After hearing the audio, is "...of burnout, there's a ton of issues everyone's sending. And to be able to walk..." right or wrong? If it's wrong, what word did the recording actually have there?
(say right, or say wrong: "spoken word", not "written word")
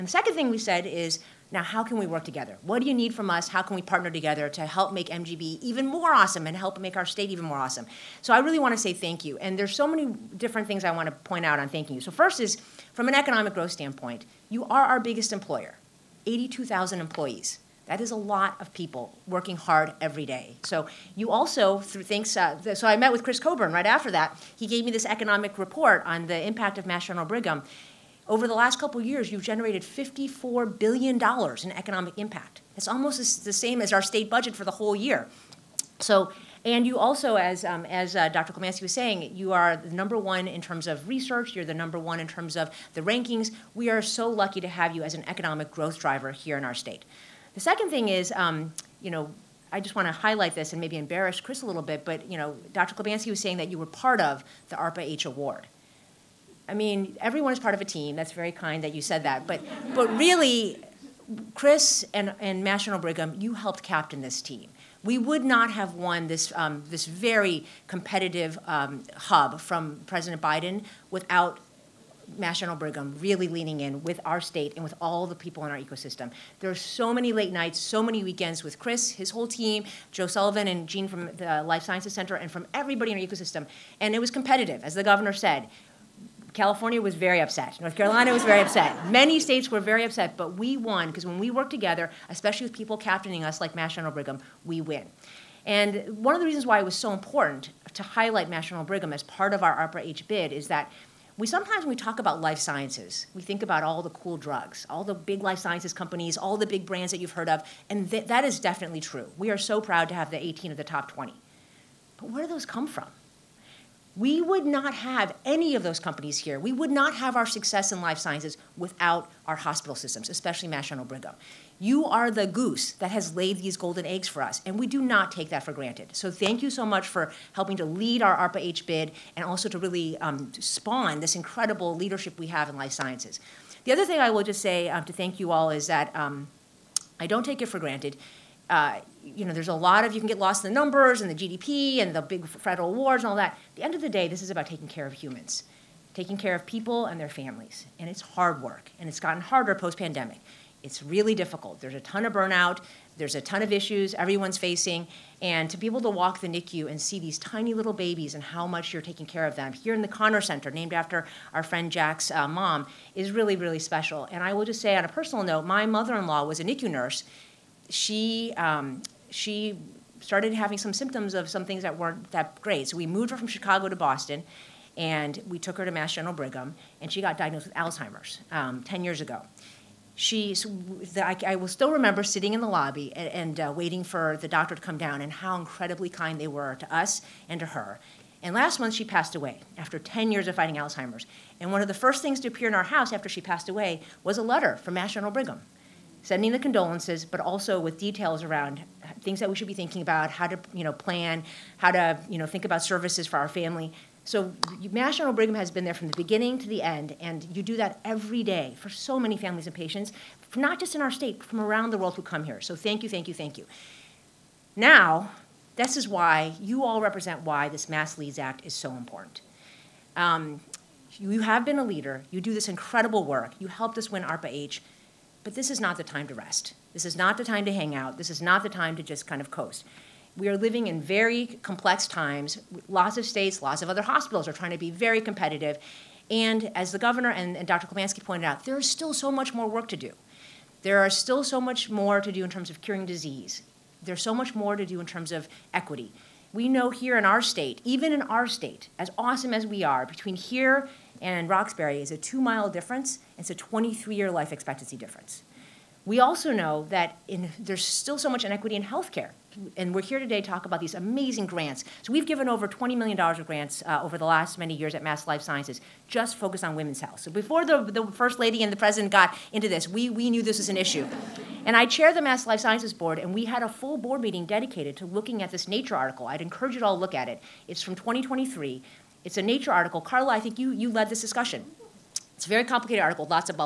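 wrong: "facing", not "sending".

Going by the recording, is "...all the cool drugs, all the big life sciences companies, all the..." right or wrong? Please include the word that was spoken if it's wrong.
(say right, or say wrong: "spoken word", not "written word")
right.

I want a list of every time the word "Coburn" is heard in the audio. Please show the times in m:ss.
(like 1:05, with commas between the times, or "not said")
0:23.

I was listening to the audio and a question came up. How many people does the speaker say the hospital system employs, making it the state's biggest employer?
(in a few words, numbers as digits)
82,000.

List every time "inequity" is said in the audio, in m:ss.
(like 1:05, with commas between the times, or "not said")
4:18.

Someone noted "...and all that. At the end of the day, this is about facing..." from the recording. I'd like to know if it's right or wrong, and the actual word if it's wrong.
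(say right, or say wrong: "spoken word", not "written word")
wrong: "taking", not "facing".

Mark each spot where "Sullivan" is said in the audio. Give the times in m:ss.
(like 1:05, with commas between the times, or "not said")
1:20.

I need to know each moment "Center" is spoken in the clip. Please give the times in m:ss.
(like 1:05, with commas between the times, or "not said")
1:22, 2:40.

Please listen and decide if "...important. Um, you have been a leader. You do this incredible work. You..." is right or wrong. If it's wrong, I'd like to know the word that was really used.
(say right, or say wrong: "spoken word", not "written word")
right.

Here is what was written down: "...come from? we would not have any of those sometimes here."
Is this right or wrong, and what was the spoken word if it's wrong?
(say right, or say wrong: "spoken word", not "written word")
wrong: "companies", not "sometimes".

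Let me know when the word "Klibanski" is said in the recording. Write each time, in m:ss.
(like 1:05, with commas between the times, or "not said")
0:38, 0:52, 3:57.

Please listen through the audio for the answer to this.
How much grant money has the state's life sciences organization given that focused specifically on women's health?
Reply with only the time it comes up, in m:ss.
4:22.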